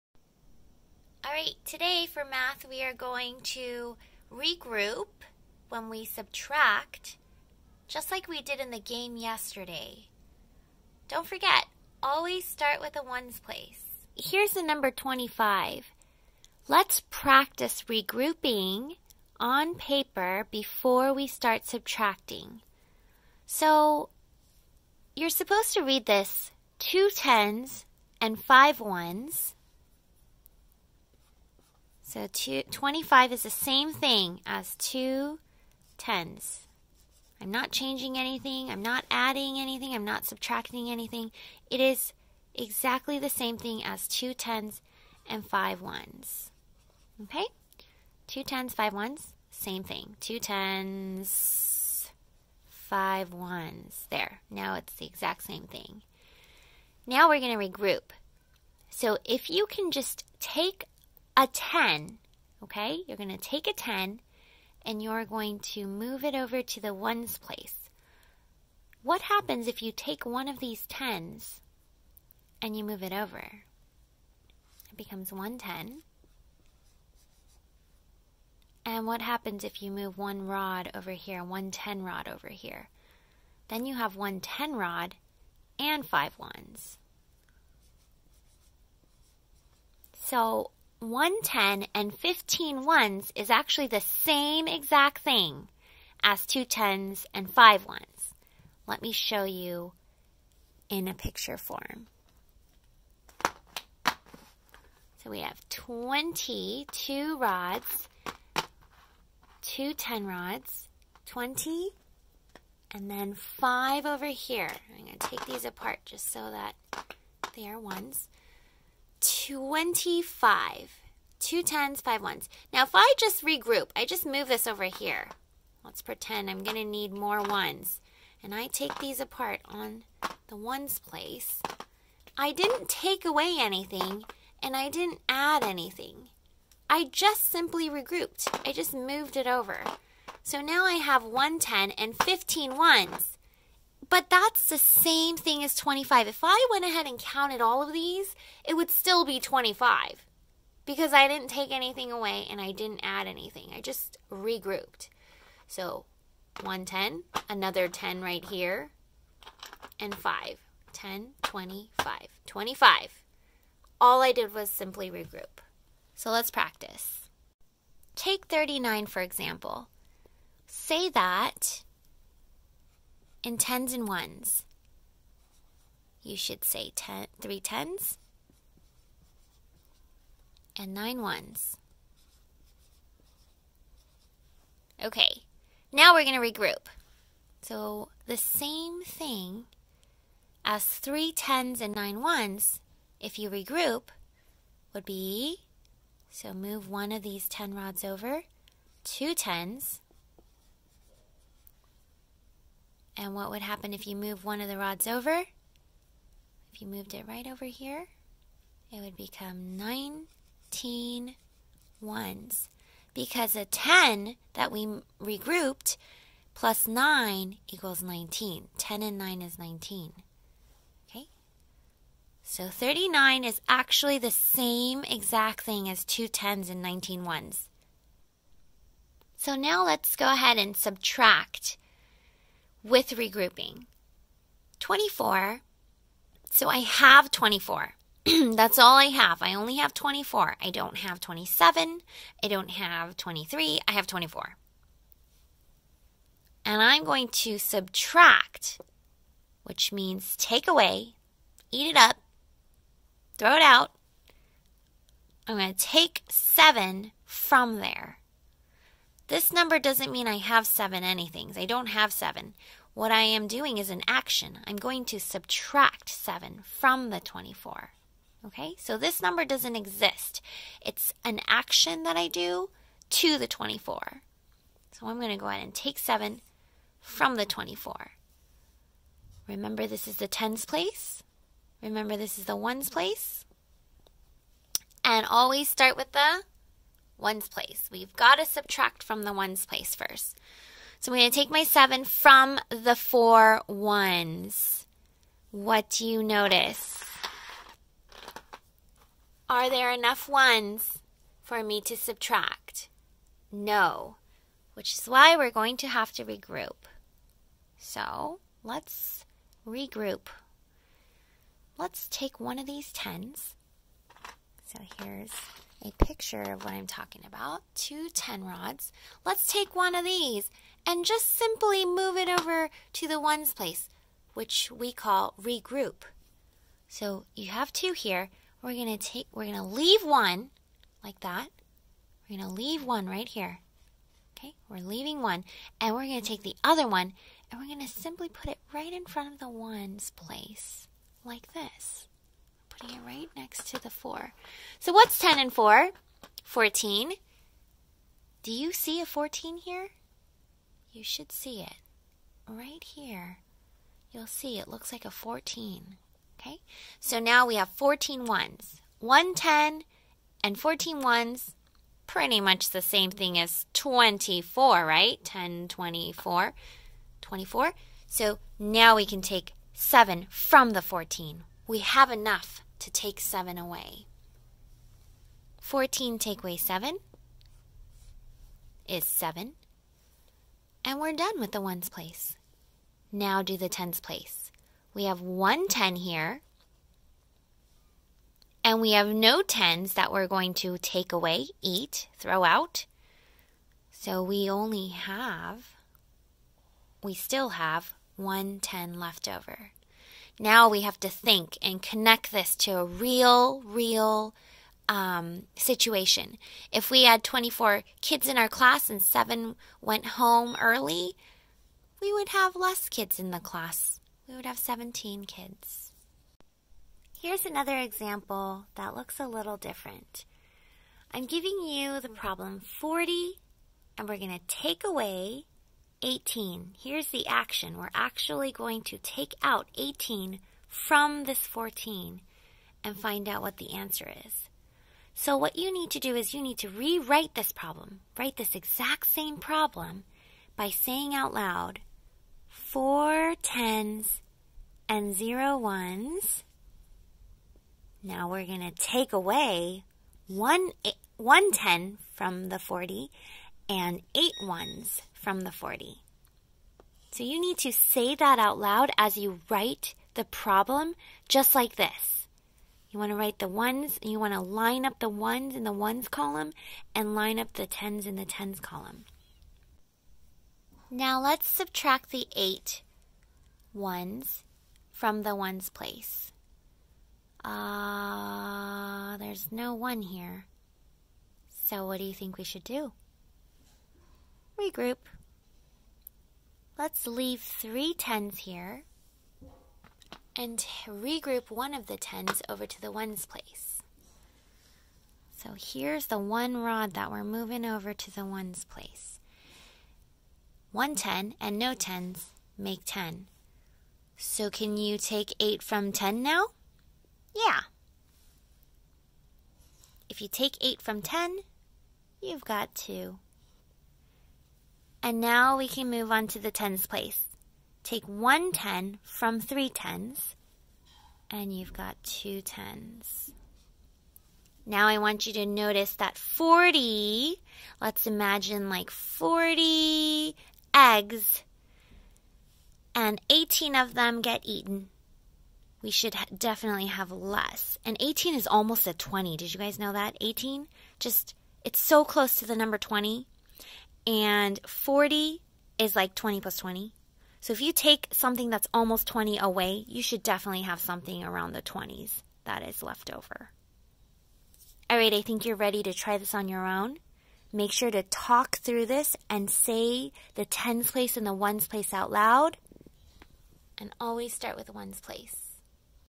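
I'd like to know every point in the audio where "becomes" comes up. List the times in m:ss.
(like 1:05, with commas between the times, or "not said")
1:14, 3:29.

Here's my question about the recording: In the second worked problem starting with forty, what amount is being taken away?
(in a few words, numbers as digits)
18.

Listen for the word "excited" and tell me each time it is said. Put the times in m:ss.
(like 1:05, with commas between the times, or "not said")
not said.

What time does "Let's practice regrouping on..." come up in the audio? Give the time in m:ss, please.
0:16.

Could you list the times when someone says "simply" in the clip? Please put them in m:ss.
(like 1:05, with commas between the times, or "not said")
2:17, 2:44, 5:21, 5:37.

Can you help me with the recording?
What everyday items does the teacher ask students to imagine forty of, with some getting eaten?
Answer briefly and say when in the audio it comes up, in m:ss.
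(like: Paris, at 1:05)
Eggs, at 8:48.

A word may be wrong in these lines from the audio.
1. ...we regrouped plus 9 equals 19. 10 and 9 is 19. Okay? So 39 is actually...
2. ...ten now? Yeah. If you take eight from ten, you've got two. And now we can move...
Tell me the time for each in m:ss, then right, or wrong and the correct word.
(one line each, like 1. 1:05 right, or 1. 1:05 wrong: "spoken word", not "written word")
1. 3:34 right
2. 8:25 right.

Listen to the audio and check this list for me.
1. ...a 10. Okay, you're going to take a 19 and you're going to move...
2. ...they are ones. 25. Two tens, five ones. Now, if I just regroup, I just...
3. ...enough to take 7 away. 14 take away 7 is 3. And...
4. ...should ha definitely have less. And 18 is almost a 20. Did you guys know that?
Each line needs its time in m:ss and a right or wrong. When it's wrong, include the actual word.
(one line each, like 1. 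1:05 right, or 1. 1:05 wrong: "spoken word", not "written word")
1. 1:01 wrong: "10", not "19"
2. 1:57 right
3. 6:12 wrong: "7", not "3"
4. 8:55 right.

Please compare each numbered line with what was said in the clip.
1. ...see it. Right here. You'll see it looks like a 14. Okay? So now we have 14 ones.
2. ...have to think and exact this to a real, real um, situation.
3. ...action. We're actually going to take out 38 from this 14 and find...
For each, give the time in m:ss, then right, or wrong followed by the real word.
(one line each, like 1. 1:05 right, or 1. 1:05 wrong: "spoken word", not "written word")
1. 5:51 right
2. 6:40 wrong: "connect", not "exact"
3. 7:07 wrong: "18", not "38".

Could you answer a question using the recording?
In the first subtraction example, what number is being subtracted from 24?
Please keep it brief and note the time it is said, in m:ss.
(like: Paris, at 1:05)
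7, at 4:15.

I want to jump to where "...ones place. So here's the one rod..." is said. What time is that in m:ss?
8:12.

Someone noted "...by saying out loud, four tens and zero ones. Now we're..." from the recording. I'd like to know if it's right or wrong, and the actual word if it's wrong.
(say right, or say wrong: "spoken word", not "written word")
right.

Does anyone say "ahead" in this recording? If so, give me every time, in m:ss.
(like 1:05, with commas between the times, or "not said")
2:26, 3:50, 4:35.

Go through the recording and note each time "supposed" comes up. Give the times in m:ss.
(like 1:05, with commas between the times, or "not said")
0:25.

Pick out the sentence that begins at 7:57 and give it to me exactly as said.
Ah, uh, there's no one here.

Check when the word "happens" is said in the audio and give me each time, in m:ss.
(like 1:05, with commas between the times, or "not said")
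1:09, 1:19, 3:23.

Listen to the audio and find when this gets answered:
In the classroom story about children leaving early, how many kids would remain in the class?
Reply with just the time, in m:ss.
6:54.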